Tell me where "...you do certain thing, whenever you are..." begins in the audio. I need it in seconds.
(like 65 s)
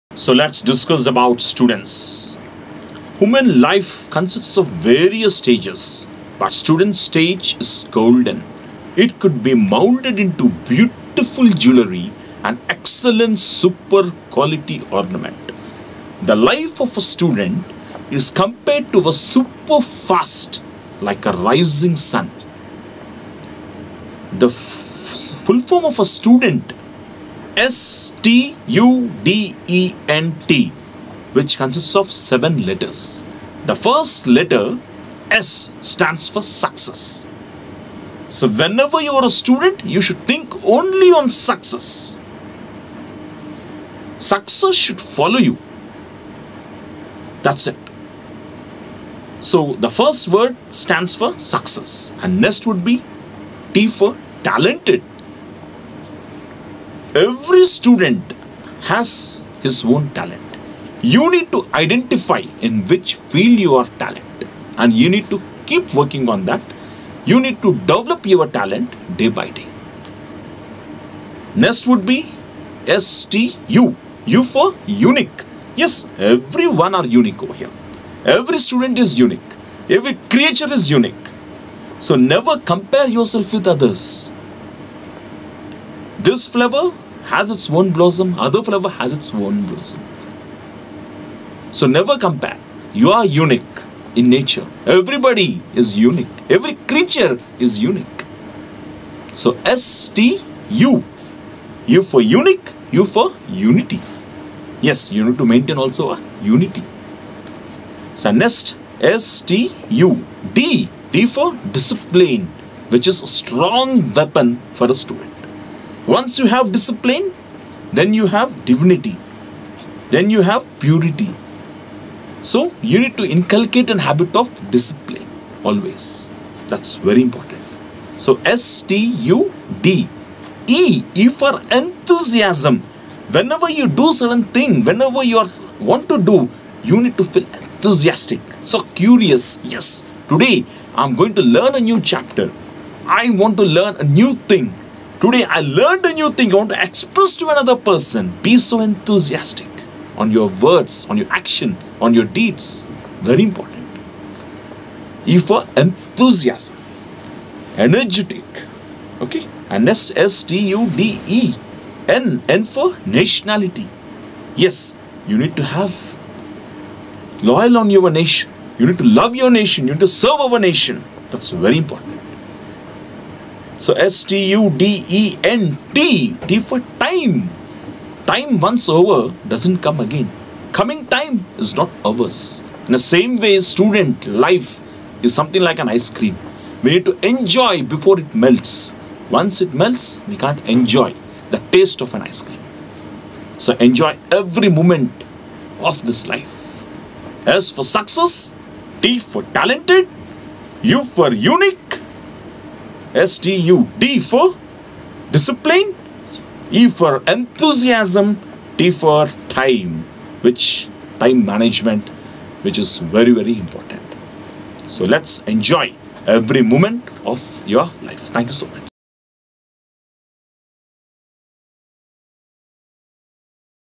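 133 s.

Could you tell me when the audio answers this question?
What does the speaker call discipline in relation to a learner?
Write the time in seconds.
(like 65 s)
113 s.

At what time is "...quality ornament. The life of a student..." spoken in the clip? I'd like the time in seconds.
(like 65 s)
14 s.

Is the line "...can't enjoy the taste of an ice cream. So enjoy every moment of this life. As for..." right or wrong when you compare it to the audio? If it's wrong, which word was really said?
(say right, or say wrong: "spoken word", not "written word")
right.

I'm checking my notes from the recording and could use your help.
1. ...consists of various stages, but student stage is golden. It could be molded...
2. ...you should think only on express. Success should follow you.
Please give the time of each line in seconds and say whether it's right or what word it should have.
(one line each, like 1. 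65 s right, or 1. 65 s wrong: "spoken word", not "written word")
1. 4 s right
2. 39 s wrong: "success", not "express".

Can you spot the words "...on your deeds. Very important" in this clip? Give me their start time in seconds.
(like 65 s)
152 s.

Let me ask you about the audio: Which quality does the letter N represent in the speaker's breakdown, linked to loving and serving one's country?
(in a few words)
Nationality.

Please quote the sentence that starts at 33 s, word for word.
The first letter S stands for success.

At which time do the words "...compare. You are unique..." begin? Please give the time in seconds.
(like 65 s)
92 s.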